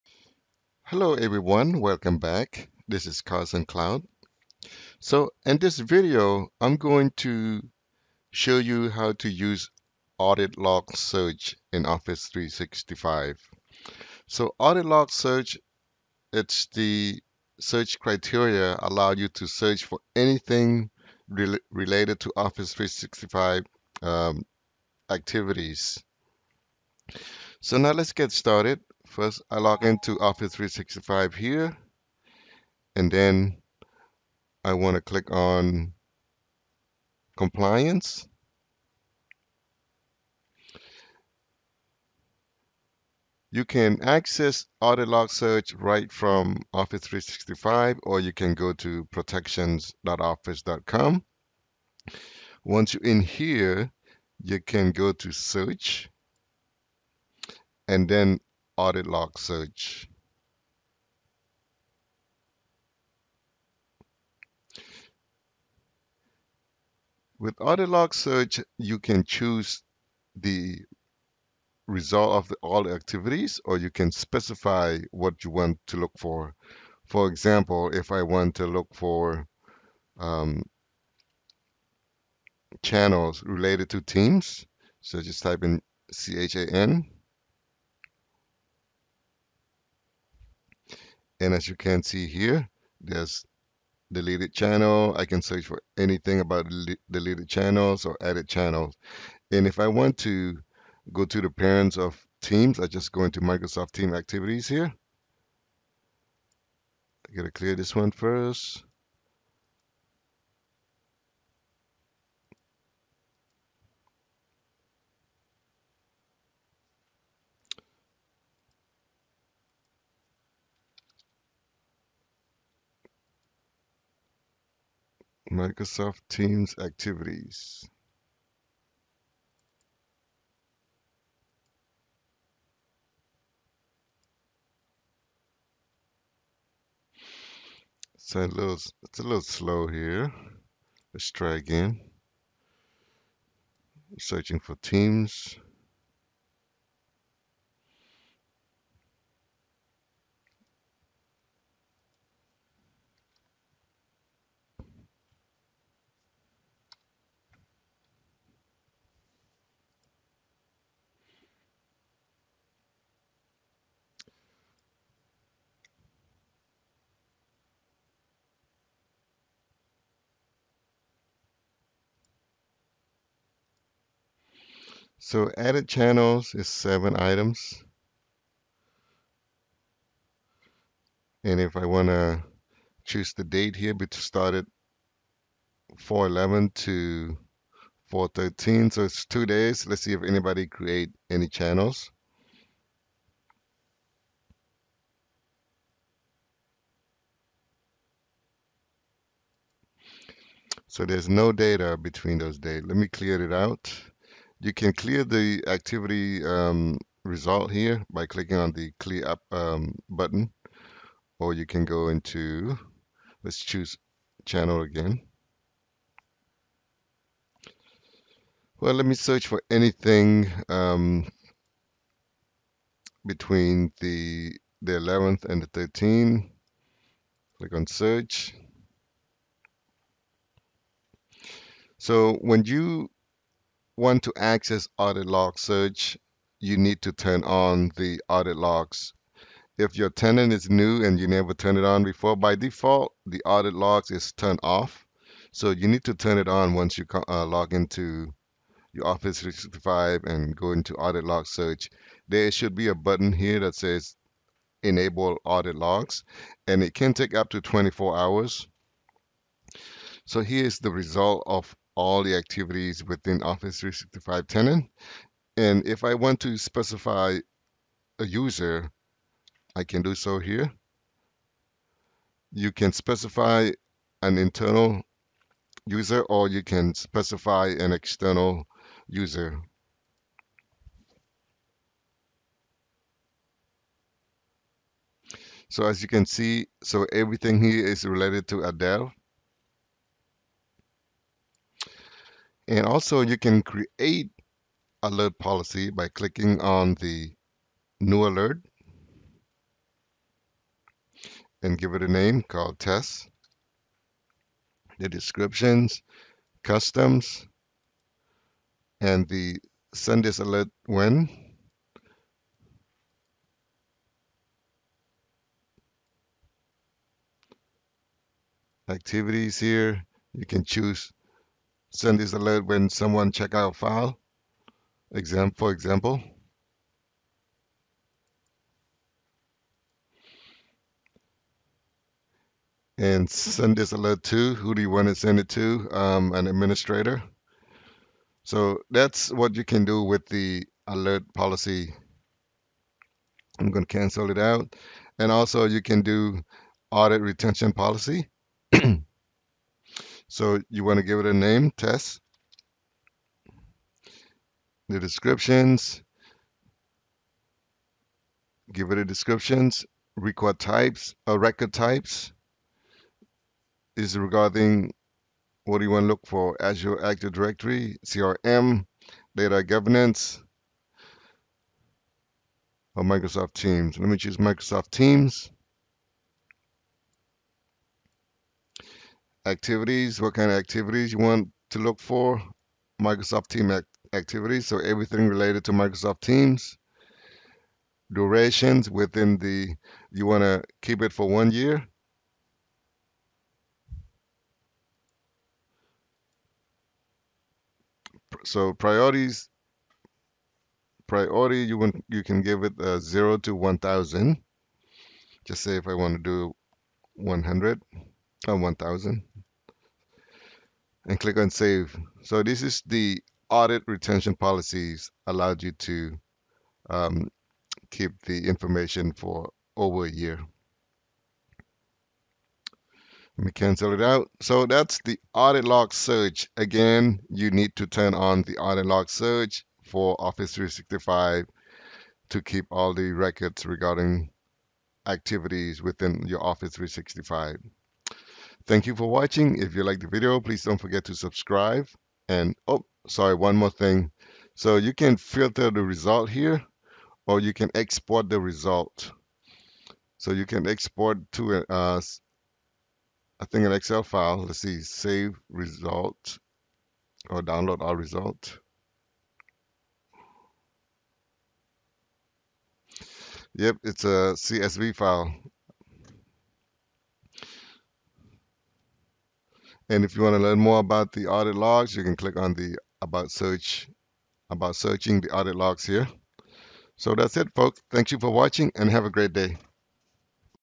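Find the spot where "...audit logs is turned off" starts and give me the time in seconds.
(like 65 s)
243 s.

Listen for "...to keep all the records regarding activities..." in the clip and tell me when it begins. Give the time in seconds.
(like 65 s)
432 s.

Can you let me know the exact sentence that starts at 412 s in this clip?
So this is the audit retention policies allowed you to um, keep the information for over a year.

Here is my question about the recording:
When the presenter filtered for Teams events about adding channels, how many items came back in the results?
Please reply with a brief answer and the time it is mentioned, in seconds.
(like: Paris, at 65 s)
7, at 176 s.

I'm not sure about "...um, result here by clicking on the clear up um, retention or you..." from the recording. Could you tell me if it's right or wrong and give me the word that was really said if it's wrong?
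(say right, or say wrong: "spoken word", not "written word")
wrong: "button", not "retention".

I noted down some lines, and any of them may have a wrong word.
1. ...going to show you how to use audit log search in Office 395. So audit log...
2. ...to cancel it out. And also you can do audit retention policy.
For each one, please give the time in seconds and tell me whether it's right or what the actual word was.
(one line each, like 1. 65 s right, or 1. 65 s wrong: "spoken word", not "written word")
1. 6 s wrong: "365", not "395"
2. 343 s right.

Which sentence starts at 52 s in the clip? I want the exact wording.
Once you're in here, you can go to search and then audit log search.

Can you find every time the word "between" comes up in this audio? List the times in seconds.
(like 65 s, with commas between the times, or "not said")
201 s, 223 s.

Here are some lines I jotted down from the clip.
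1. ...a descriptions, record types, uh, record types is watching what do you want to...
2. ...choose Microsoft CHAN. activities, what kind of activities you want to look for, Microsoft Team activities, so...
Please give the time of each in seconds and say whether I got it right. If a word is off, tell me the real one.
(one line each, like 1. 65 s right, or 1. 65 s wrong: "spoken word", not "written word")
1. 358 s wrong: "regarding", not "watching"
2. 374 s wrong: "Teams", not "CHAN".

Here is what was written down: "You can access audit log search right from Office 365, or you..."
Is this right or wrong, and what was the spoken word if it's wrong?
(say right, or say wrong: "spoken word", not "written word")
right.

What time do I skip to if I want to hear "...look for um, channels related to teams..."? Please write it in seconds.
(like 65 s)
78 s.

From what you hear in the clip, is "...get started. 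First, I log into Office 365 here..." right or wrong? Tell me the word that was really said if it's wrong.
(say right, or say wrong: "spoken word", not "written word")
right.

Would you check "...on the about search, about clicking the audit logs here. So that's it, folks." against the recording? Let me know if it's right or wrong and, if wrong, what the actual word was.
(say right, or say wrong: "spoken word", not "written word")
wrong: "searching", not "clicking".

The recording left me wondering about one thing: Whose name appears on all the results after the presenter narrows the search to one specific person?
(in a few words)
Adele.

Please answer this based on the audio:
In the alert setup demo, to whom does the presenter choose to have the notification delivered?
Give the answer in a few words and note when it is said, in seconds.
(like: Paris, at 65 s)
an administrator, at 336 s.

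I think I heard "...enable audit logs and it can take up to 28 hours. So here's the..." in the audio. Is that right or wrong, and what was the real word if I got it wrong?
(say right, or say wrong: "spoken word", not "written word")
wrong: "24", not "28".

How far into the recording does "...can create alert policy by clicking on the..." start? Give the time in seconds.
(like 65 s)
293 s.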